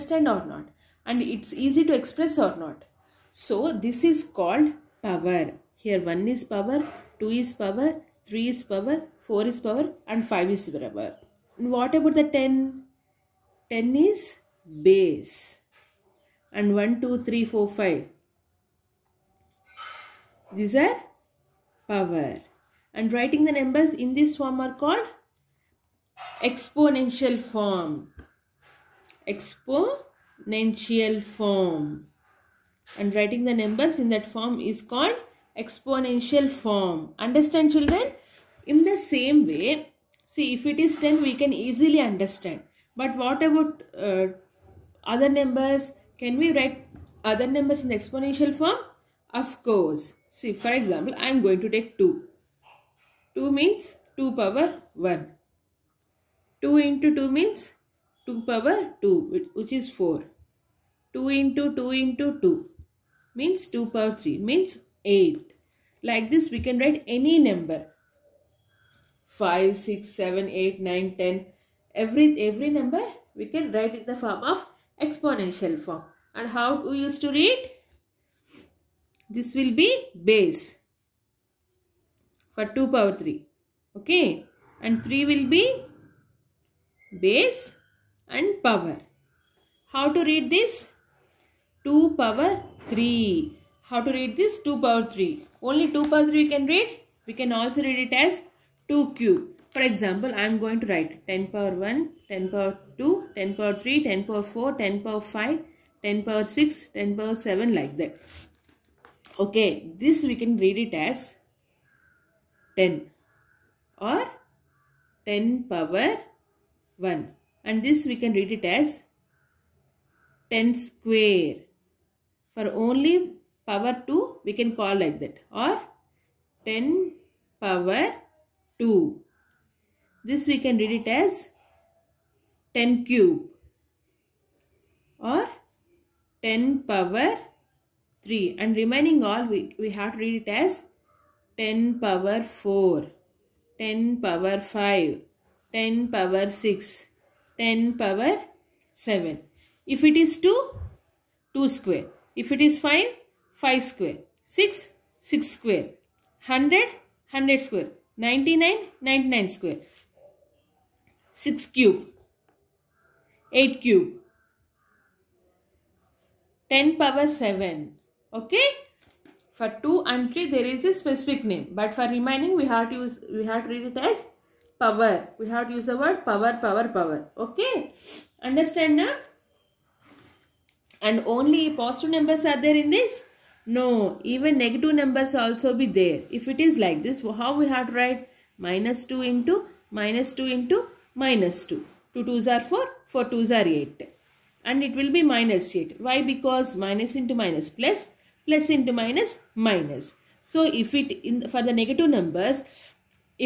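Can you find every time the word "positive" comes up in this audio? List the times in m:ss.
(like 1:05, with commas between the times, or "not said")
3:01.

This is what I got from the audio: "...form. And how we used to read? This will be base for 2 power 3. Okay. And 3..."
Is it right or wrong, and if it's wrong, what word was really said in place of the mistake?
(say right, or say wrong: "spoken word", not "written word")
right.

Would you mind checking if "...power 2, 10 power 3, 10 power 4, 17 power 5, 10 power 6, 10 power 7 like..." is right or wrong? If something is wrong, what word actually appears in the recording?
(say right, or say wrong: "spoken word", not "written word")
wrong: "10", not "17".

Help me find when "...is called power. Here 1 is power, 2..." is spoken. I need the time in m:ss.
0:04.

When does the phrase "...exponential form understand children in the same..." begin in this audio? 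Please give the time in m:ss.
0:35.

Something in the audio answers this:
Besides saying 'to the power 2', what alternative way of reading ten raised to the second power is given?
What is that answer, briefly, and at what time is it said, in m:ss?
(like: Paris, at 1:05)
10 square, at 2:00.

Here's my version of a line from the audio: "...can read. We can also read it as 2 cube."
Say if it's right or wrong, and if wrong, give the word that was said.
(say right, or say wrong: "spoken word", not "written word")
right.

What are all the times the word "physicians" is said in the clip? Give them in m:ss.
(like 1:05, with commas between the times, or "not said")
not said.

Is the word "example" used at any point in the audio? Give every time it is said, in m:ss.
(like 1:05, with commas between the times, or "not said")
0:50, 1:39.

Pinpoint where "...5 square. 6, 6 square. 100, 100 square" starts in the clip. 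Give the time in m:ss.
2:33.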